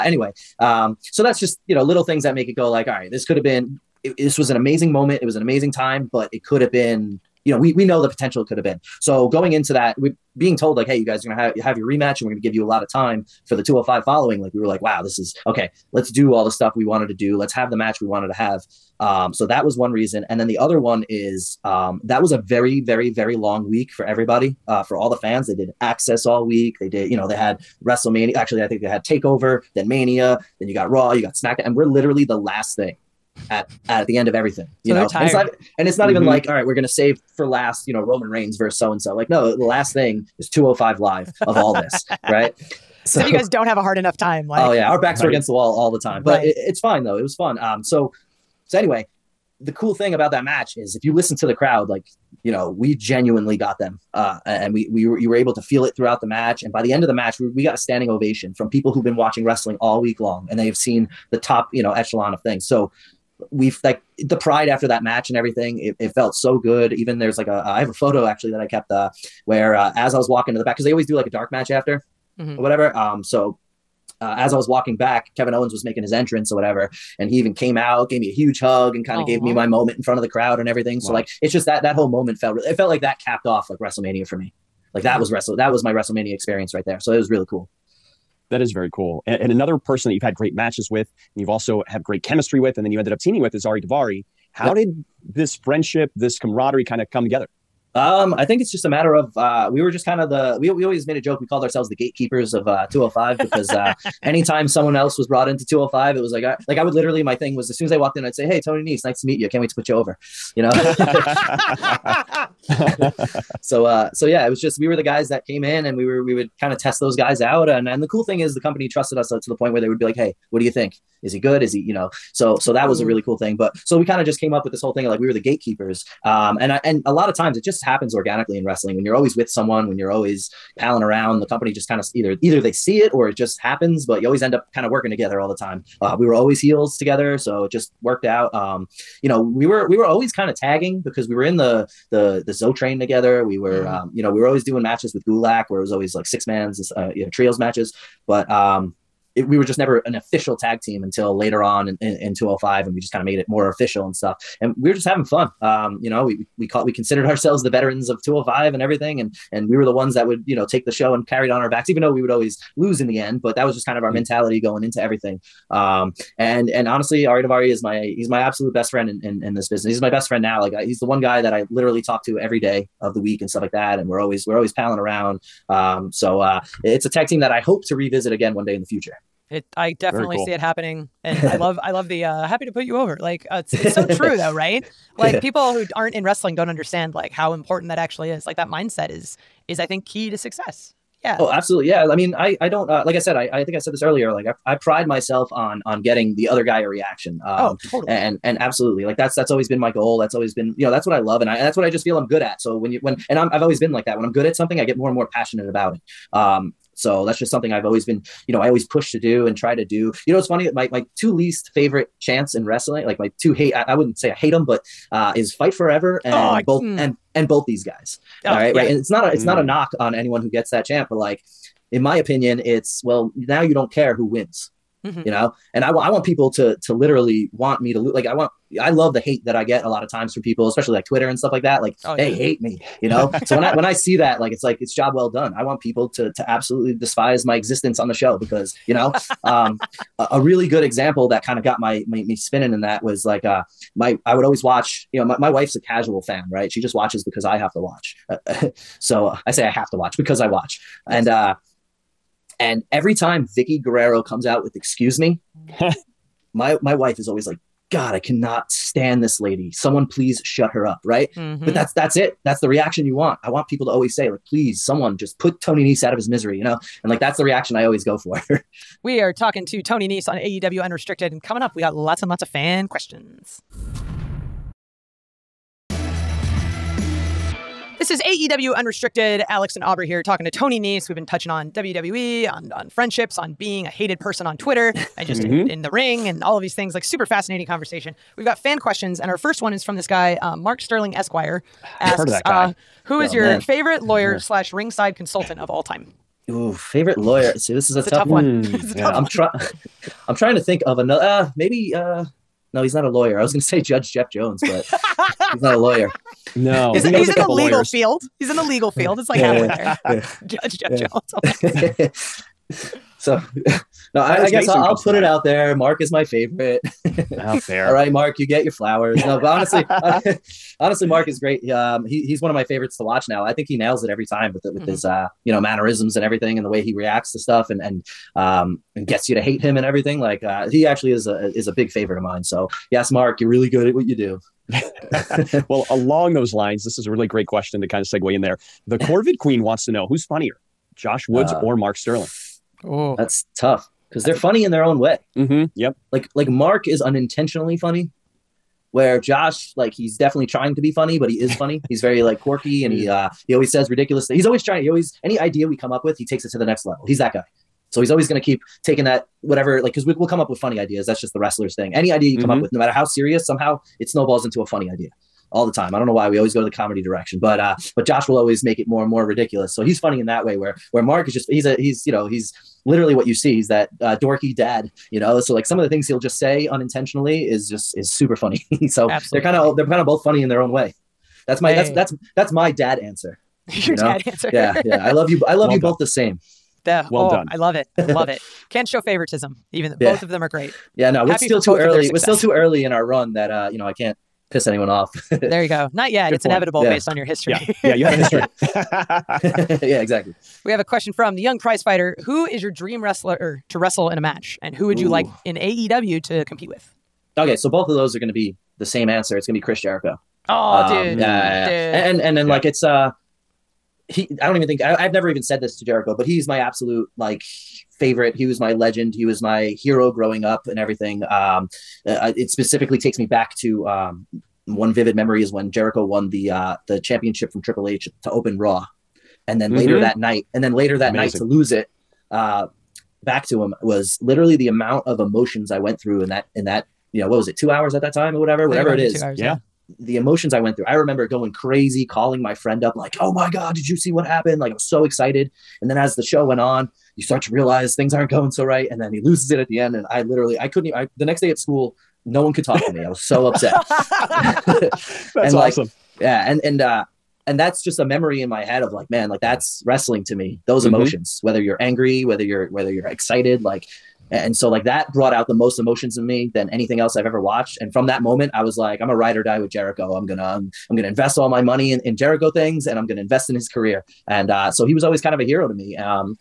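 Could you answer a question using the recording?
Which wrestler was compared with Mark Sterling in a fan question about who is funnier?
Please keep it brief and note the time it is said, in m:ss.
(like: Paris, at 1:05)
Josh Woods, at 5:40.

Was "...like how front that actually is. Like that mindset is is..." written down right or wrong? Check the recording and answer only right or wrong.
wrong.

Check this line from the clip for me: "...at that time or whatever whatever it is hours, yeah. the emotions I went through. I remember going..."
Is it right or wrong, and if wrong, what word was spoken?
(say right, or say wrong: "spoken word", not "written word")
right.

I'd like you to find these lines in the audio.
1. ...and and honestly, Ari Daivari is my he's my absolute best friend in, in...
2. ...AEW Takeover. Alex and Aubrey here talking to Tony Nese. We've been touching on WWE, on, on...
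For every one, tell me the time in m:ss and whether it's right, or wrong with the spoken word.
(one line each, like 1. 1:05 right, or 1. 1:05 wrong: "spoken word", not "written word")
1. 2:46 right
2. 4:38 wrong: "Unrestricted", not "Takeover".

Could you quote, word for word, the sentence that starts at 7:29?
And I literally, I couldn't even, I, the next day at school, no one could talk to me.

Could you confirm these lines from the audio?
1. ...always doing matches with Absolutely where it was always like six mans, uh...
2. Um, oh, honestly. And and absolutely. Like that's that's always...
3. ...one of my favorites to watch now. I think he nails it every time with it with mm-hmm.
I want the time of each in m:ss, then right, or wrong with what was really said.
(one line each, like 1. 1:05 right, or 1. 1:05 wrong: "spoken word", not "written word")
1. 2:24 wrong: "Gulak", not "Absolutely"
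2. 3:17 wrong: "totally", not "honestly"
3. 5:22 right.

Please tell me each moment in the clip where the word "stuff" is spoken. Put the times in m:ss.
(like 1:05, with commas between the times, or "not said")
0:16, 2:34, 2:53, 3:51, 5:27.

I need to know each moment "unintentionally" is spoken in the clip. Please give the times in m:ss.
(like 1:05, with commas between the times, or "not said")
5:46, 6:16.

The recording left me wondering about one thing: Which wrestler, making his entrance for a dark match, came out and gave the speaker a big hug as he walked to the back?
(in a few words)
Kevin Owens.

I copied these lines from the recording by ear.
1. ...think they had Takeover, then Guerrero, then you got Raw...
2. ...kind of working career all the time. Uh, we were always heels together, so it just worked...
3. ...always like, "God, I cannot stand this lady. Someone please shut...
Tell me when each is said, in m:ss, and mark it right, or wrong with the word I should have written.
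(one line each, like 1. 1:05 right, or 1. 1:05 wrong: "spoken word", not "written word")
1. 0:28 wrong: "Mania", not "Guerrero"
2. 2:14 wrong: "together", not "career"
3. 4:17 right.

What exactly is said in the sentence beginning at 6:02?
up with no matter how serious somehow it snowballs into a funny idea all the time.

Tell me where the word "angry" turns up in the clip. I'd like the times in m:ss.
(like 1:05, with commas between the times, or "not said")
7:41.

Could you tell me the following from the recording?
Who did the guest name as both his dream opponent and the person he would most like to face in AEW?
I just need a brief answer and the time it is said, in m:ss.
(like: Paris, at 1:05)
Chris Jericho, at 6:49.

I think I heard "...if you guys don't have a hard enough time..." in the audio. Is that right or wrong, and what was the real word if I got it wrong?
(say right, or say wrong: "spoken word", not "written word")
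right.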